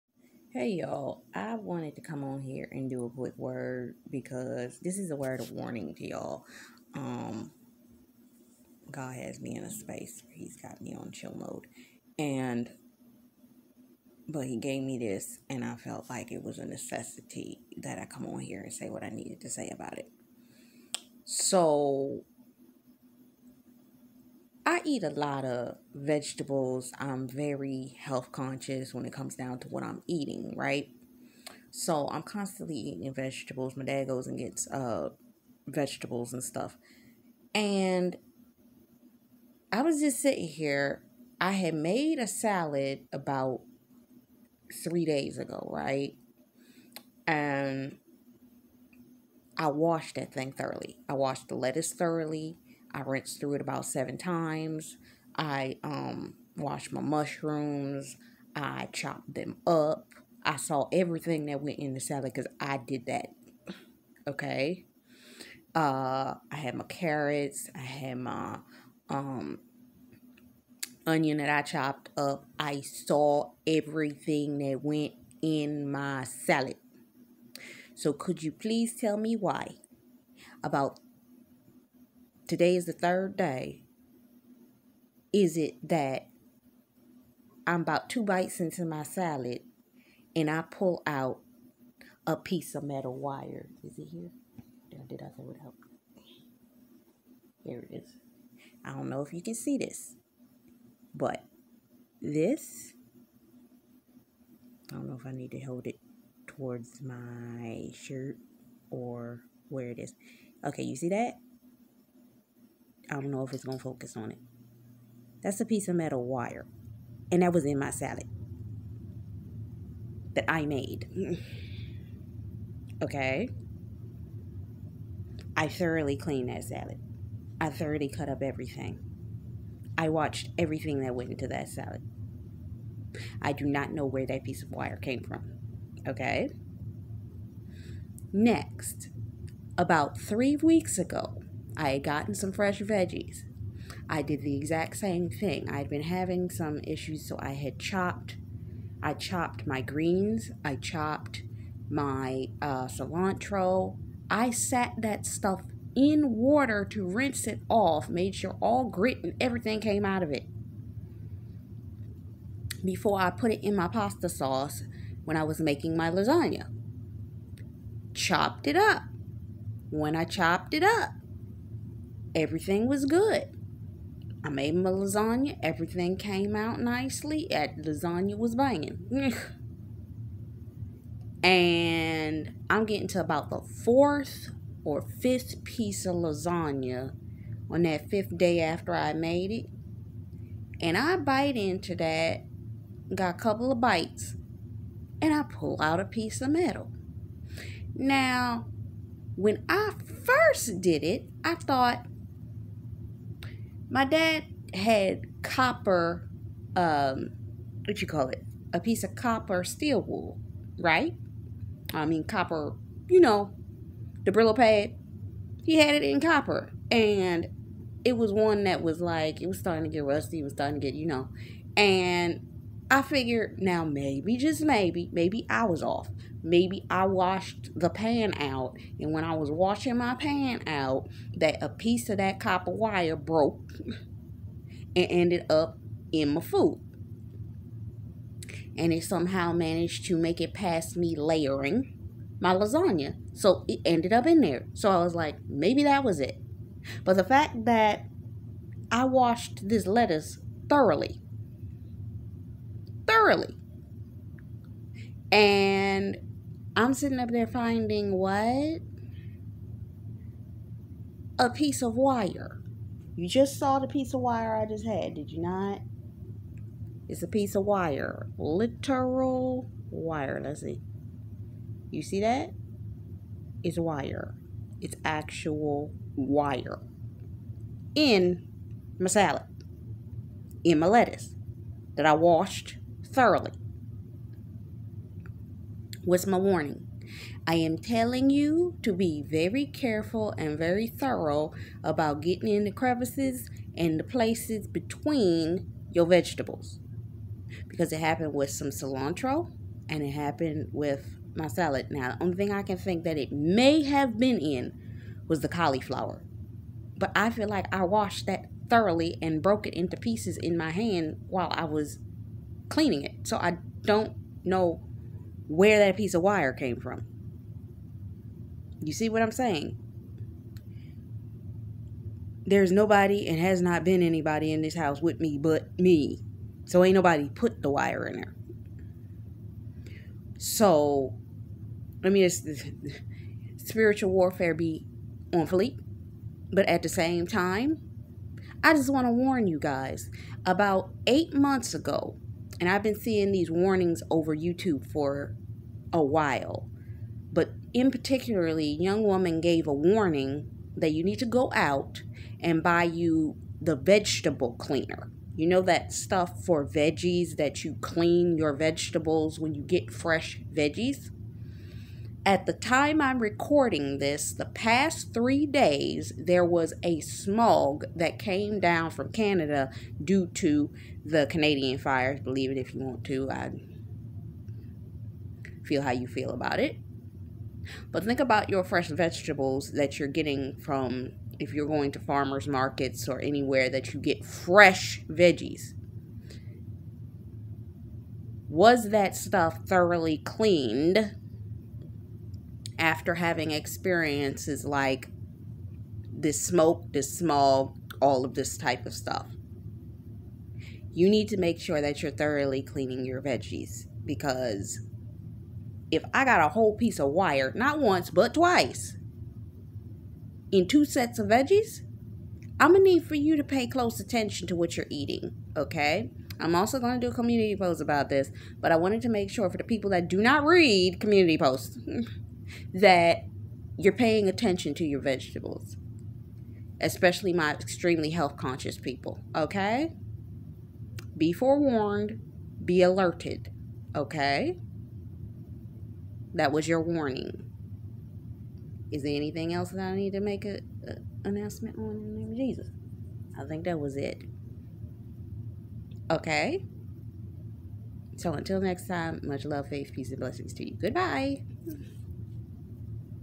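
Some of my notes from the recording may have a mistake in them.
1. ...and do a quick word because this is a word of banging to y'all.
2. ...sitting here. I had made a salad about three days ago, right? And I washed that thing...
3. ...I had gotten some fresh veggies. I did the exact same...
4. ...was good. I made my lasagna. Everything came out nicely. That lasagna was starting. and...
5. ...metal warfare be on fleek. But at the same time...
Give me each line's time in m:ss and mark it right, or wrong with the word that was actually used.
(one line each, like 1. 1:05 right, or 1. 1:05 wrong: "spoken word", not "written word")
1. 0:02 wrong: "warning", not "banging"
2. 0:40 right
3. 2:21 right
4. 2:52 wrong: "banging", not "starting"
5. 5:33 wrong: "spiritual", not "metal".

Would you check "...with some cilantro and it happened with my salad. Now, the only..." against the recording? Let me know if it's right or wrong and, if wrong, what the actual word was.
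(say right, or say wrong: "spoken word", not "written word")
right.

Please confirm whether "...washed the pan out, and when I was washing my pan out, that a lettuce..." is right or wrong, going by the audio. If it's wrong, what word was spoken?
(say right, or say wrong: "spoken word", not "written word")
wrong: "piece", not "lettuce".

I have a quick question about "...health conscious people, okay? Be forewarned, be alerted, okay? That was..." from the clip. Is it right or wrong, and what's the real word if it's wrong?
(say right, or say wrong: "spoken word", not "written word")
right.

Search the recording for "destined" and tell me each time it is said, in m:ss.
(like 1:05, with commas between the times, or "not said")
not said.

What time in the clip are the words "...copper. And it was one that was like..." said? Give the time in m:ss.
3:36.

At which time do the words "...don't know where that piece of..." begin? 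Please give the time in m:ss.
5:13.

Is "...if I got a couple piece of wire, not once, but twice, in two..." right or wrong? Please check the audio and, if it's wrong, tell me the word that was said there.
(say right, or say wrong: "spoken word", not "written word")
wrong: "whole", not "couple".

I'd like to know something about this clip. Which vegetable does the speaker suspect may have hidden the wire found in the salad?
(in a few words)
cauliflower.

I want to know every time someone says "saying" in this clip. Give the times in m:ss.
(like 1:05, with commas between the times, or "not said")
5:19.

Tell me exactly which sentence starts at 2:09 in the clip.
I watched everything that went into that salad.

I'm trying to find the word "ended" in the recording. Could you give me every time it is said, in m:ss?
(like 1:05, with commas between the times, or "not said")
3:55, 4:03.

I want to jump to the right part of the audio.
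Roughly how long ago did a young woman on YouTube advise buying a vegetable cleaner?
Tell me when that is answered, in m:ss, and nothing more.
5:41.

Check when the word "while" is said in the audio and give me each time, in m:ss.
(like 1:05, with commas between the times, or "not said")
5:11, 5:46.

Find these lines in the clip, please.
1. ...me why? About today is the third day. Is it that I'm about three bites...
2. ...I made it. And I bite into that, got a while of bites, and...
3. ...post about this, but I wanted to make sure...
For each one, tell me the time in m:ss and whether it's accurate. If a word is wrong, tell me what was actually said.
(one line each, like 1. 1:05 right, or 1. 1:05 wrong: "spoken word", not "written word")
1. 1:19 wrong: "two", not "three"
2. 3:08 wrong: "couple", not "while"
3. 6:57 right.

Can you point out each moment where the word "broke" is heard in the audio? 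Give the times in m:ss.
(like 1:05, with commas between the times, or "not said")
3:53, 5:09.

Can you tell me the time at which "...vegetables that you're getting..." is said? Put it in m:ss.
6:18.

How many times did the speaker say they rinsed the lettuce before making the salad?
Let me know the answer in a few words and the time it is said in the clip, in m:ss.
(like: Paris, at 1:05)
7, at 0:53.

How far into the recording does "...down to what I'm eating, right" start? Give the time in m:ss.
0:29.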